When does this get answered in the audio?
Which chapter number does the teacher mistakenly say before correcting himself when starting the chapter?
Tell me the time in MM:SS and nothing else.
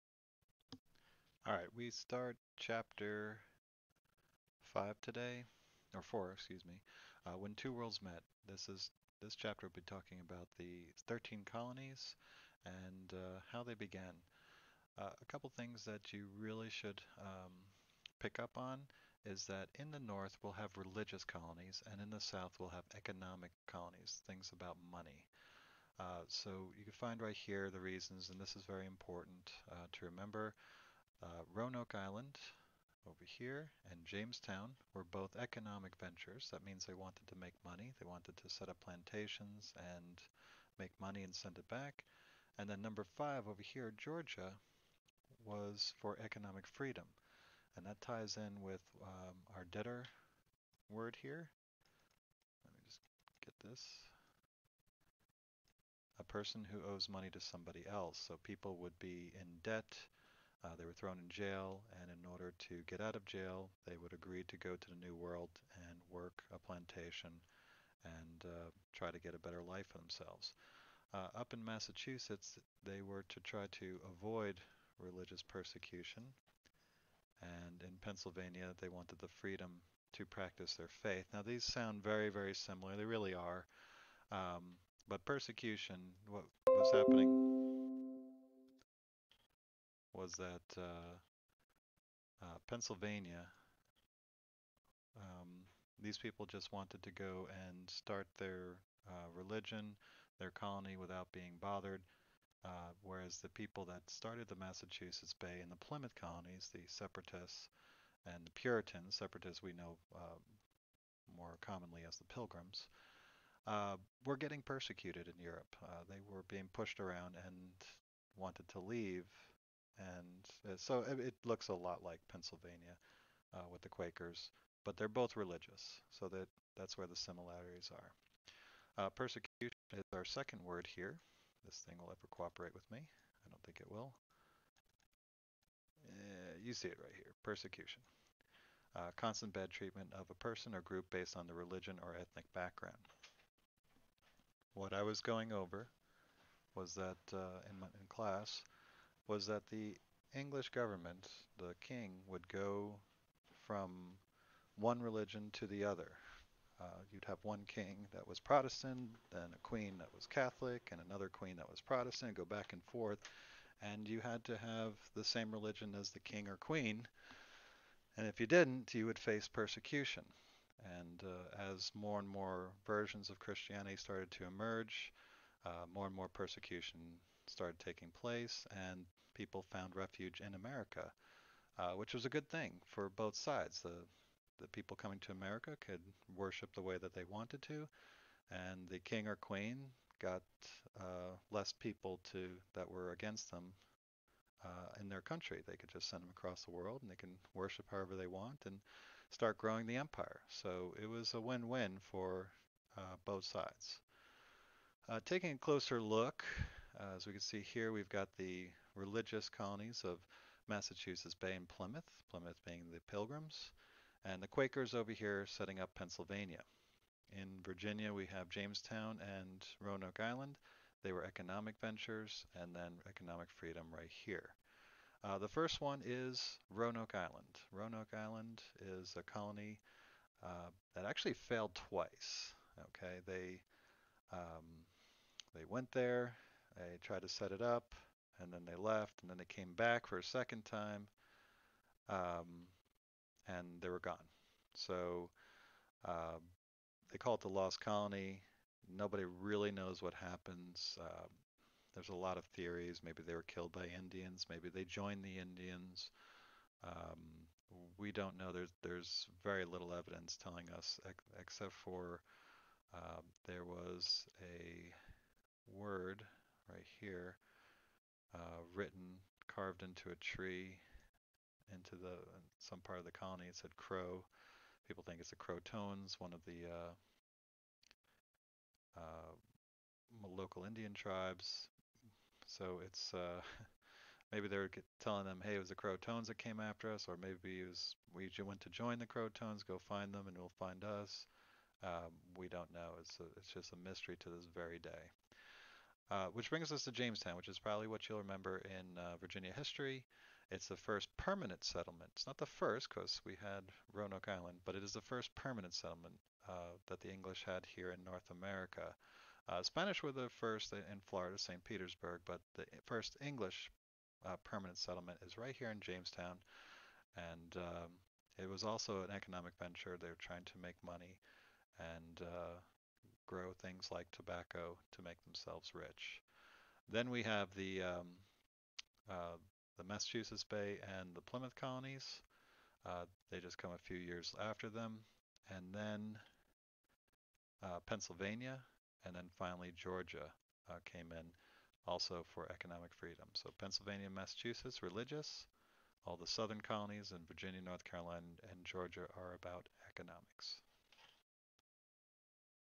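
00:02.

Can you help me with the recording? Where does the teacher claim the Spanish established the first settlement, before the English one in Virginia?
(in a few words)
St. Petersburg.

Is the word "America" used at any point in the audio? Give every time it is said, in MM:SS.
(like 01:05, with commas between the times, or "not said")
03:00, 03:05, 05:08.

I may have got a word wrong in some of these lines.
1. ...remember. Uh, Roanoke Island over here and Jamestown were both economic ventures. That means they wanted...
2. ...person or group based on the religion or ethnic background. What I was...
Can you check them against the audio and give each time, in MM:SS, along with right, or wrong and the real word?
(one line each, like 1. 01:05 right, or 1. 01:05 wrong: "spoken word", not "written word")
1. 00:30 right
2. 02:20 right.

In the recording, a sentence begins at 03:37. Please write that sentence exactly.
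In Virginia, we have Jamestown and Roanoke Island.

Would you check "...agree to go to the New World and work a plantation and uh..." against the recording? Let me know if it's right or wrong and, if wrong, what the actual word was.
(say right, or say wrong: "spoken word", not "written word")
right.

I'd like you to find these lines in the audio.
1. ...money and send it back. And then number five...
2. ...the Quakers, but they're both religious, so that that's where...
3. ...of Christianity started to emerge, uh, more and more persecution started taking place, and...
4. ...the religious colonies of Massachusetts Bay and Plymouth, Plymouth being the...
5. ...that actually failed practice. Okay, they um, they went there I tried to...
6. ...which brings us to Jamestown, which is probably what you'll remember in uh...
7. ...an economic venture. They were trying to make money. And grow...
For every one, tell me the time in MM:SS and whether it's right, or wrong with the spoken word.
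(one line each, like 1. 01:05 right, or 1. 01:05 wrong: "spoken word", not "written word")
1. 00:40 right
2. 02:03 right
3. 02:53 right
4. 03:28 right
5. 03:50 wrong: "twice", not "practice"
6. 04:56 right
7. 05:19 right.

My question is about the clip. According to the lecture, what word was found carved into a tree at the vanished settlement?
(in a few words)
crow.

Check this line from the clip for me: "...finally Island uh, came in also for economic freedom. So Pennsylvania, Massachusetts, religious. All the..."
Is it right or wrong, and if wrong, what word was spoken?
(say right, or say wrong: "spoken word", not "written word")
wrong: "Georgia", not "Island".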